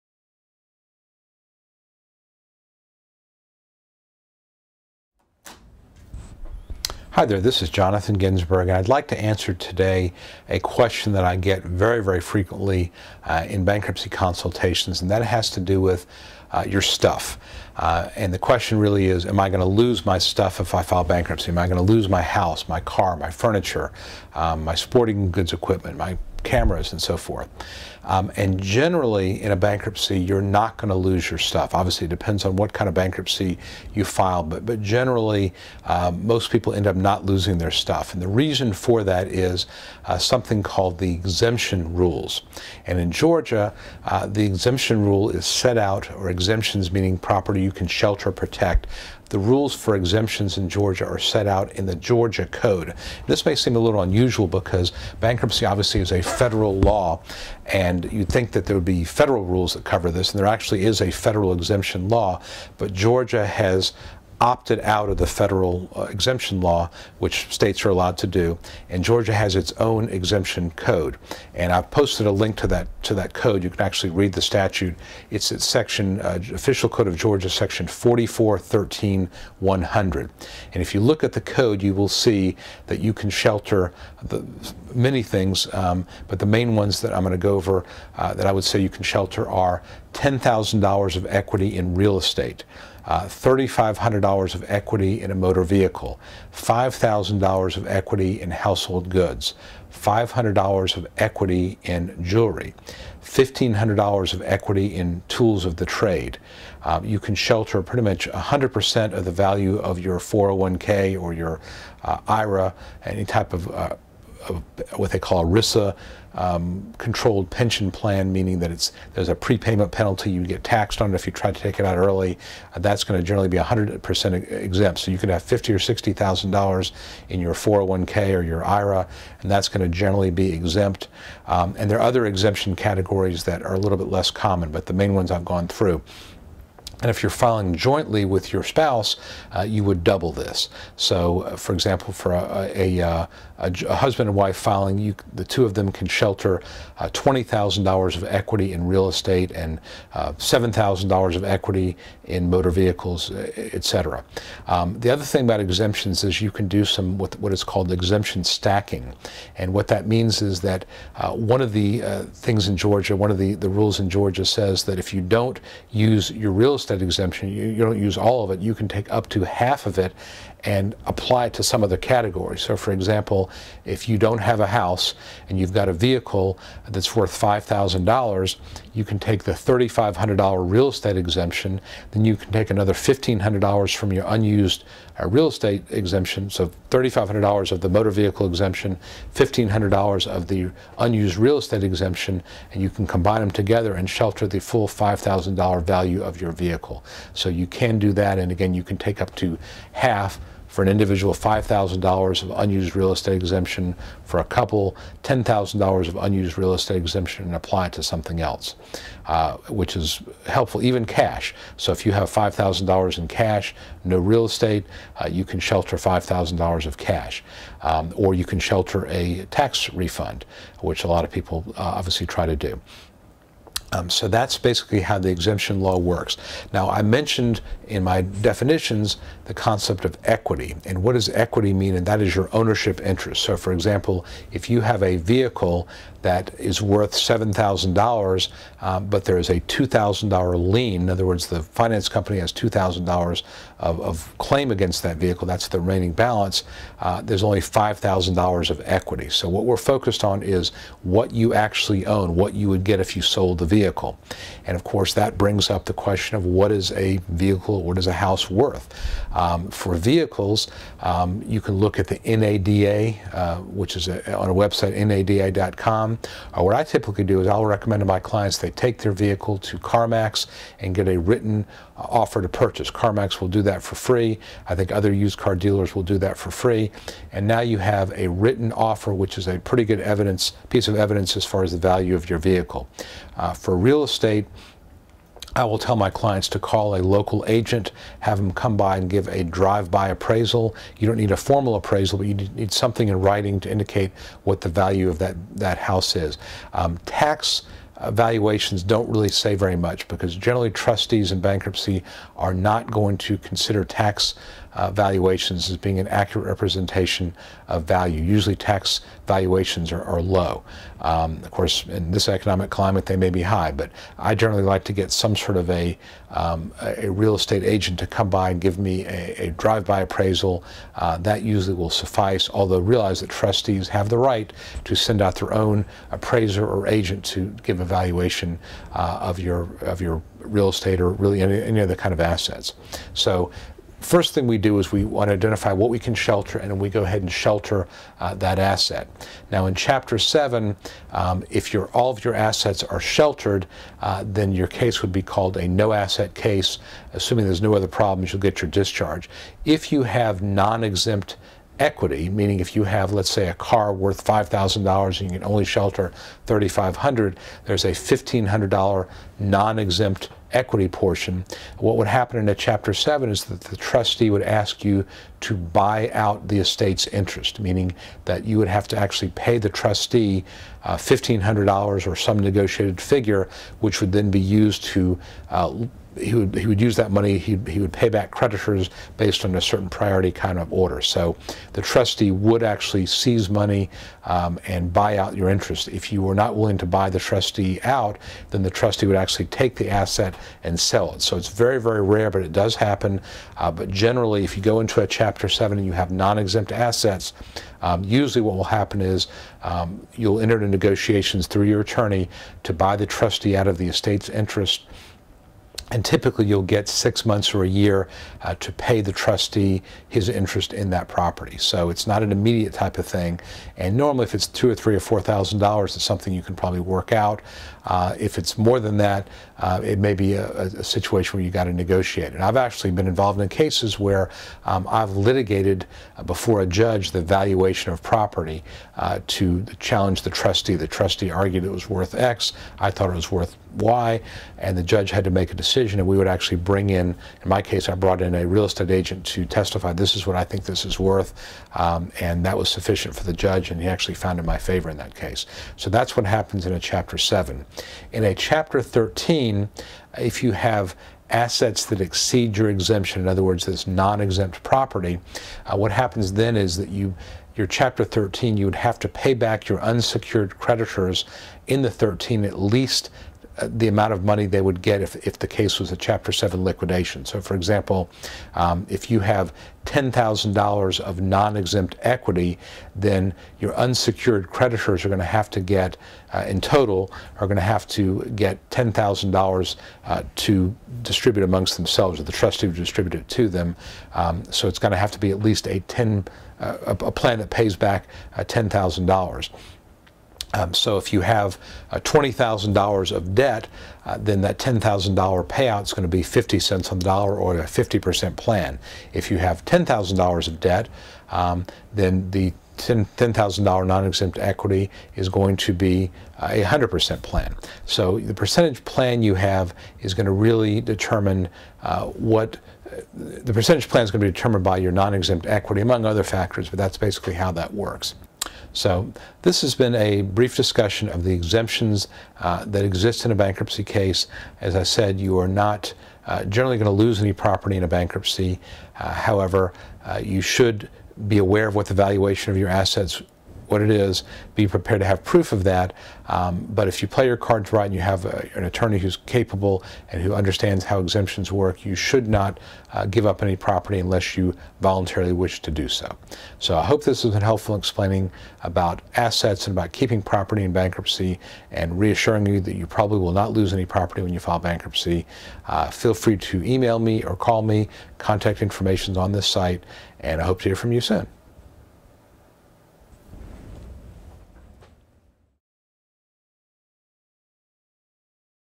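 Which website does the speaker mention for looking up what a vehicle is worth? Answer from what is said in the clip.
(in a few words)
NADA.com.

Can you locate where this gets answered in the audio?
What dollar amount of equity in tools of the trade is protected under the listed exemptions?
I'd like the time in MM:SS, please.
01:43.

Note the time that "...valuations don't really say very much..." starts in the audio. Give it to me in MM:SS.
04:58.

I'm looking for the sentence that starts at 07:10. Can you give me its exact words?
The trustee argued it was worth X.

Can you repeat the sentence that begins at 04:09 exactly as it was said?
So, what we're focused on is what you actually own, what you would get if you sold the vehicle vehicle.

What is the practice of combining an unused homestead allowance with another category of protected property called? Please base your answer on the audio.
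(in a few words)
exemption stacking.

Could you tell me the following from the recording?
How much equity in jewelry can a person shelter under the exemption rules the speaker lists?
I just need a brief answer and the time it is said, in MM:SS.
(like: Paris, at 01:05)
$500, at 01:39.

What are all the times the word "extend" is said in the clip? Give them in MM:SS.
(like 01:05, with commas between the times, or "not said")
not said.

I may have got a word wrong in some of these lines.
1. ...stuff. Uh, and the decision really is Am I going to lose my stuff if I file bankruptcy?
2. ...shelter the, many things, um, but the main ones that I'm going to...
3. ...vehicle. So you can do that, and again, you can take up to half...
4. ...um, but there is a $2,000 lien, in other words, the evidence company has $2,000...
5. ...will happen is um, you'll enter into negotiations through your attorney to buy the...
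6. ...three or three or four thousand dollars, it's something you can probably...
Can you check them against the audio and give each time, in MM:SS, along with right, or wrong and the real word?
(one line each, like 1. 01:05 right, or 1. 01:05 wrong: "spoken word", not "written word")
1. 00:16 wrong: "question", not "decision"
2. 01:23 right
3. 03:16 right
4. 03:58 wrong: "finance", not "evidence"
5. 06:38 right
6. 06:54 wrong: "two", not "three".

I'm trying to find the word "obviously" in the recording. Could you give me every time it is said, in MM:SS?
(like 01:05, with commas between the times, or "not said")
00:31, 00:55, 03:41.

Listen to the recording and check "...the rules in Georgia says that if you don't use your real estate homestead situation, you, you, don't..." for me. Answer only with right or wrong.
wrong.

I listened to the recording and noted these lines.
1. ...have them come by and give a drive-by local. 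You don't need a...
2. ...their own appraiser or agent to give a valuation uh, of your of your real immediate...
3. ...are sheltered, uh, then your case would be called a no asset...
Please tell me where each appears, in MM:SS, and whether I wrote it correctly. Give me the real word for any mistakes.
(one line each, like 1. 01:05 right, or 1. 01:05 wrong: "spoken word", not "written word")
1. 04:48 wrong: "appraisal", not "local"
2. 05:25 wrong: "estate", not "immediate"
3. 05:42 right.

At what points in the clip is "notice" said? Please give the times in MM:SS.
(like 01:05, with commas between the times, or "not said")
not said.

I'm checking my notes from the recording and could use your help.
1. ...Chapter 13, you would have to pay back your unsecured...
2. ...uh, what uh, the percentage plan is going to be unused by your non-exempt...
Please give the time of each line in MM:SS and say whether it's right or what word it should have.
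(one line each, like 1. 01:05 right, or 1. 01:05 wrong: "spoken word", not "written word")
1. 07:37 right
2. 08:31 wrong: "determined", not "unused".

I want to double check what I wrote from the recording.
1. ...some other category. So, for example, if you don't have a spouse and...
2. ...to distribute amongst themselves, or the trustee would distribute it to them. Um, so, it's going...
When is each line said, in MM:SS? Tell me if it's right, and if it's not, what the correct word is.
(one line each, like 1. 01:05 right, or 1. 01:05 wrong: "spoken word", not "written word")
1. 02:51 wrong: "house", not "spouse"
2. 08:00 right.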